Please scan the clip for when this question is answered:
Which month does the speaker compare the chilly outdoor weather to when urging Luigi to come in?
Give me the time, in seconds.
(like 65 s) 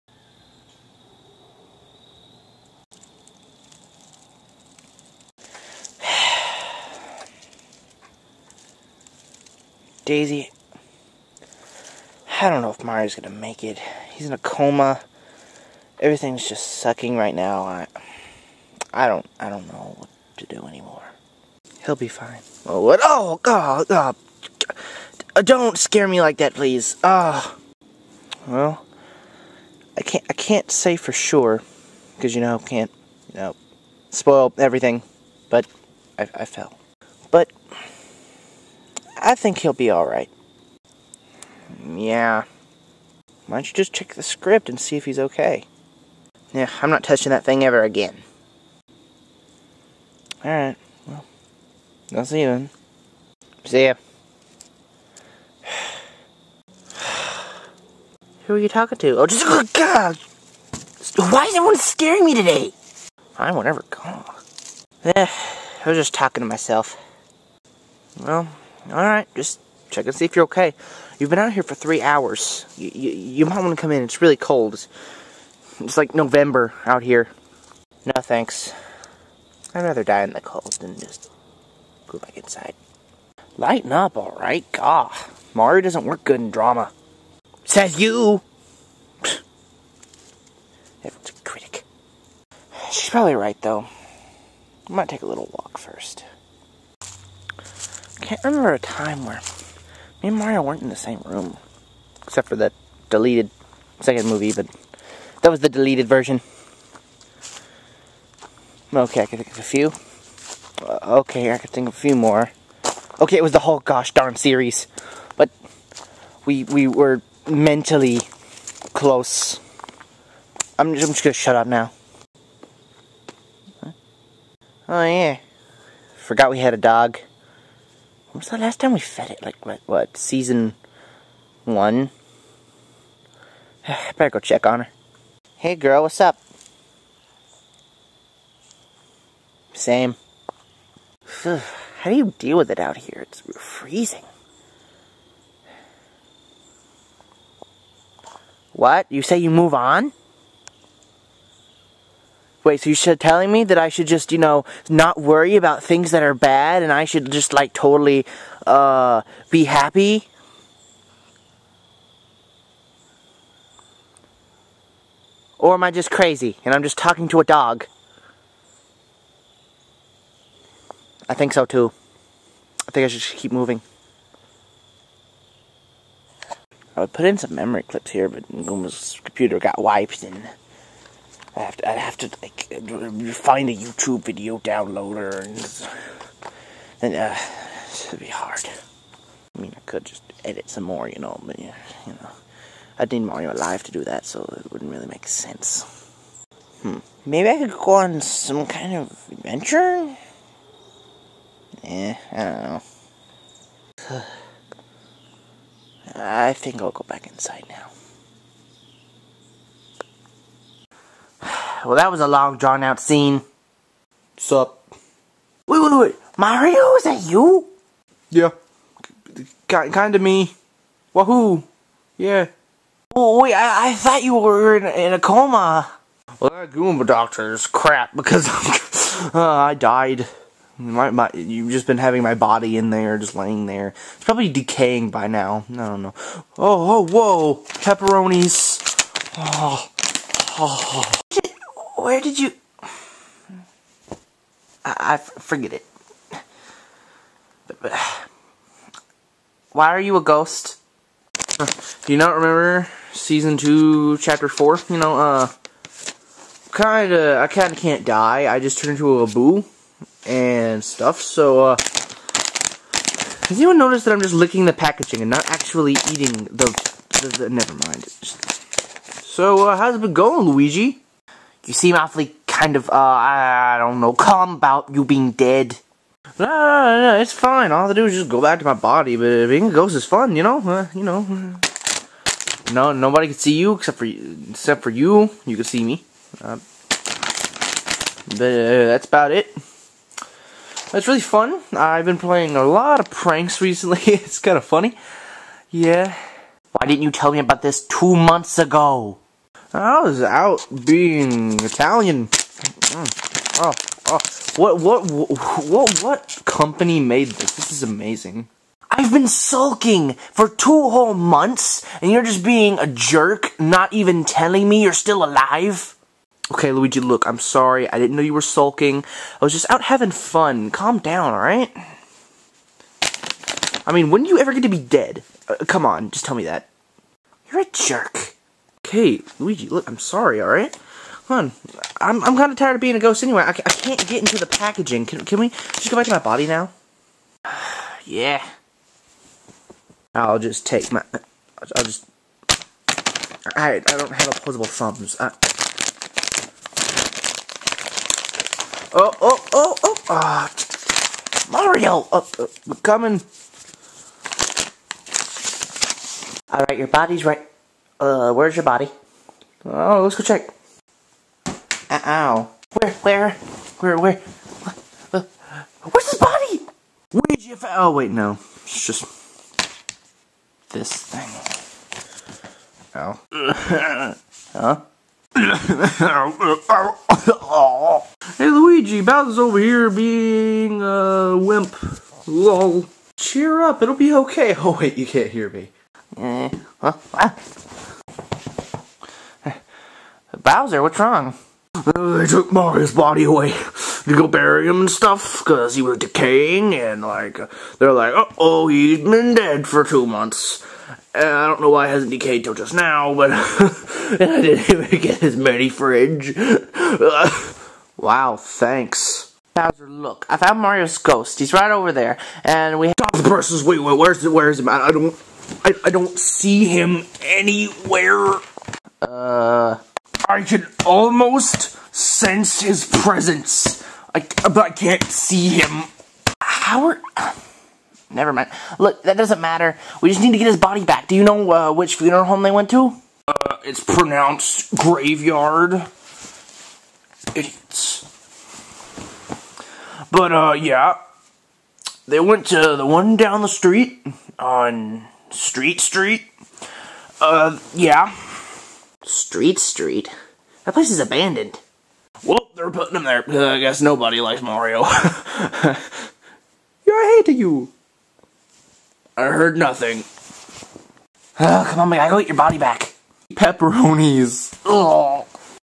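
76 s.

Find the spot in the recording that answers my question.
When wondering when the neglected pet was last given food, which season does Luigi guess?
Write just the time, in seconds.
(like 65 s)
130 s.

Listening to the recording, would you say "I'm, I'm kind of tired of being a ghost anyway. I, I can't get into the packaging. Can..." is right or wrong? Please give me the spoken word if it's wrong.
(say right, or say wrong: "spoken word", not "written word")
right.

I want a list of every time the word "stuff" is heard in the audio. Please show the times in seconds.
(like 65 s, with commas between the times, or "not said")
260 s, 394 s.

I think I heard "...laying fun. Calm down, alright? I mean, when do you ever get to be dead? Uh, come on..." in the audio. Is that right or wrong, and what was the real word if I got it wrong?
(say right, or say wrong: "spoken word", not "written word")
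wrong: "having", not "laying".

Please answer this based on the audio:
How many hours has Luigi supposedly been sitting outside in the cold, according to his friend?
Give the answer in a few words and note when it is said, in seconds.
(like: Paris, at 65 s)
3, at 71 s.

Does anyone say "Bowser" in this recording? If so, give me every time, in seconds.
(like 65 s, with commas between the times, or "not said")
379 s, 390 s, 409 s.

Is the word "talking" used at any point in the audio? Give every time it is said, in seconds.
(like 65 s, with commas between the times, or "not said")
58 s, 66 s, 166 s.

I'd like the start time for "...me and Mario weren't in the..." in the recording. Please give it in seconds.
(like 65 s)
100 s.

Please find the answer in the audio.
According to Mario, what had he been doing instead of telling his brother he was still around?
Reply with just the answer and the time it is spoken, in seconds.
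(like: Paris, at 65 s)
Being Italian, at 300 s.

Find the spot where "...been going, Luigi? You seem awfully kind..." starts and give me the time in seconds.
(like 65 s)
270 s.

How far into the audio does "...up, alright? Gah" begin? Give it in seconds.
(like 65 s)
83 s.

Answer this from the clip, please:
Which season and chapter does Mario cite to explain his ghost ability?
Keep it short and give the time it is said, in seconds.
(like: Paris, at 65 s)
Season 2, chapter 4, at 253 s.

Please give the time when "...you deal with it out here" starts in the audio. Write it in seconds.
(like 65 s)
142 s.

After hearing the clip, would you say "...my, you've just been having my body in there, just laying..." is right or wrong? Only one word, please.
right.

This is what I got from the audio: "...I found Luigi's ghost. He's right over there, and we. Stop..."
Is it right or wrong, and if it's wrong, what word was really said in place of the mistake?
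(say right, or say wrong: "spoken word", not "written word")
wrong: "Mario", not "Luigi".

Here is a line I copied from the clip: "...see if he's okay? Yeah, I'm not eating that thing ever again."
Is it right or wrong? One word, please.
wrong.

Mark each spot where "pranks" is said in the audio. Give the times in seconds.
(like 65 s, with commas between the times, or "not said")
293 s.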